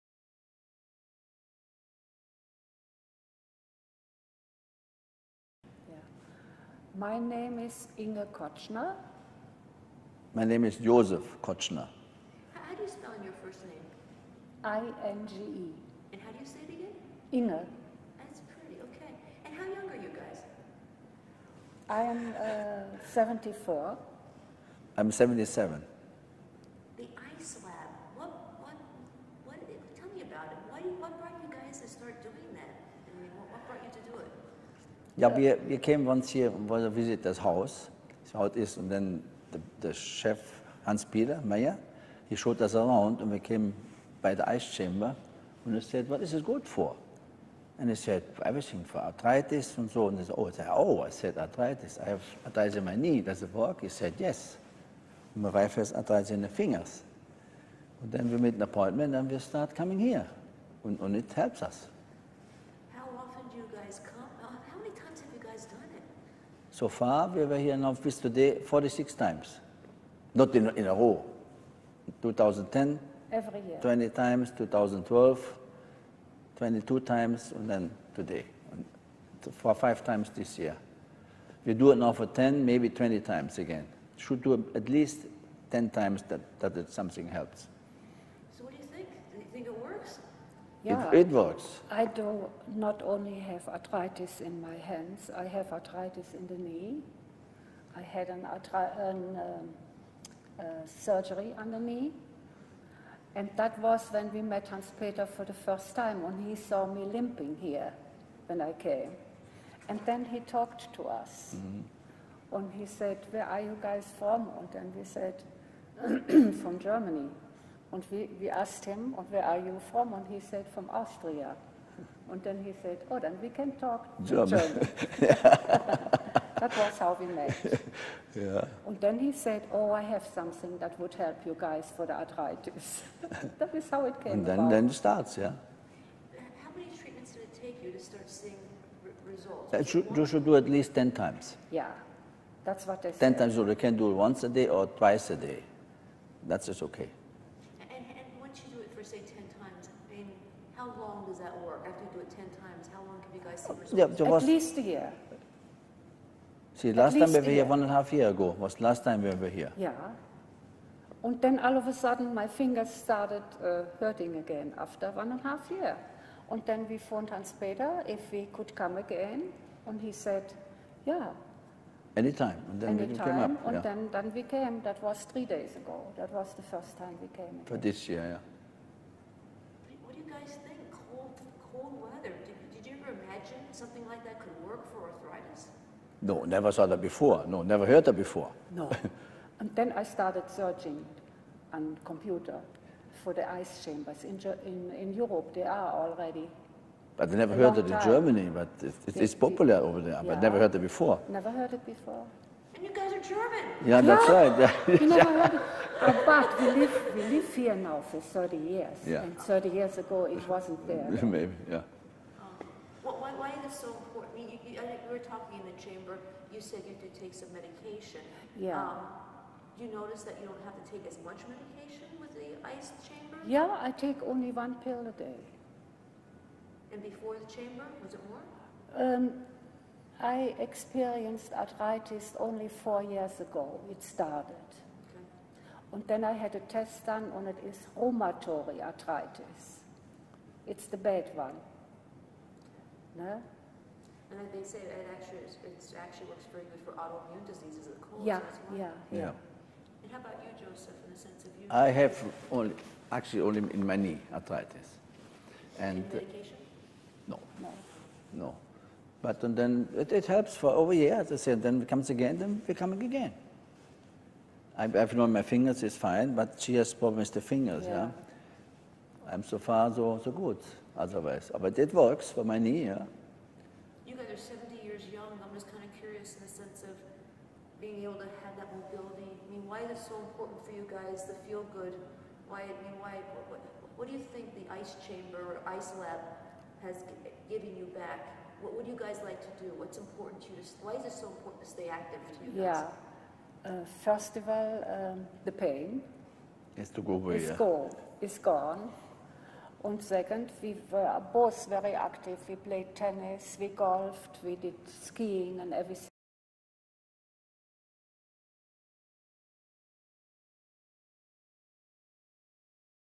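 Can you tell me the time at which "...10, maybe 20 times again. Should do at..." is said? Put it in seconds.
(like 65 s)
82 s.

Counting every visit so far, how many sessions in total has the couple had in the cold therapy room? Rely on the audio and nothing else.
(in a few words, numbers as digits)
46.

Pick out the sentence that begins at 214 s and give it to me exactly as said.
I mean, you, you, you, were talking in the chamber.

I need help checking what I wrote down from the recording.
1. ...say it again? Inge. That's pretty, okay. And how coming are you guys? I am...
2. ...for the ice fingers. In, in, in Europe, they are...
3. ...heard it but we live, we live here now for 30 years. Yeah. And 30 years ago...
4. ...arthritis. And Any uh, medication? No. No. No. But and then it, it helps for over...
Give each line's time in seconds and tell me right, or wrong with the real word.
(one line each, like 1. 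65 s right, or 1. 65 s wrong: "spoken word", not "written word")
1. 16 s wrong: "young", not "coming"
2. 193 s wrong: "chambers", not "fingers"
3. 205 s right
4. 254 s right.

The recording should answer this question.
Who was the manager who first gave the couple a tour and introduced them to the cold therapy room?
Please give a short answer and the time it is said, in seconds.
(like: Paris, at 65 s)
Hans-Peter Meyer, at 40 s.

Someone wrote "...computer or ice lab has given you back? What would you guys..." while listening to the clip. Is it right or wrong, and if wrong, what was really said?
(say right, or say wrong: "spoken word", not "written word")
wrong: "chamber", not "computer".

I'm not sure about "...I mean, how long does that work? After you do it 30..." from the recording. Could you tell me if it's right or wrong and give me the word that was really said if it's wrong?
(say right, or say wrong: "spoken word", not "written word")
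wrong: "10", not "30".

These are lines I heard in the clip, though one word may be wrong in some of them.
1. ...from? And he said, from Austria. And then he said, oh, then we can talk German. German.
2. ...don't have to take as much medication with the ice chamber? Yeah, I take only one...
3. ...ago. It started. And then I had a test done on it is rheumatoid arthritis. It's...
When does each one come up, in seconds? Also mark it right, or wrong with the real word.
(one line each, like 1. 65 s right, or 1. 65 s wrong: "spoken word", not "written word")
1. 119 s right
2. 220 s right
3. 233 s right.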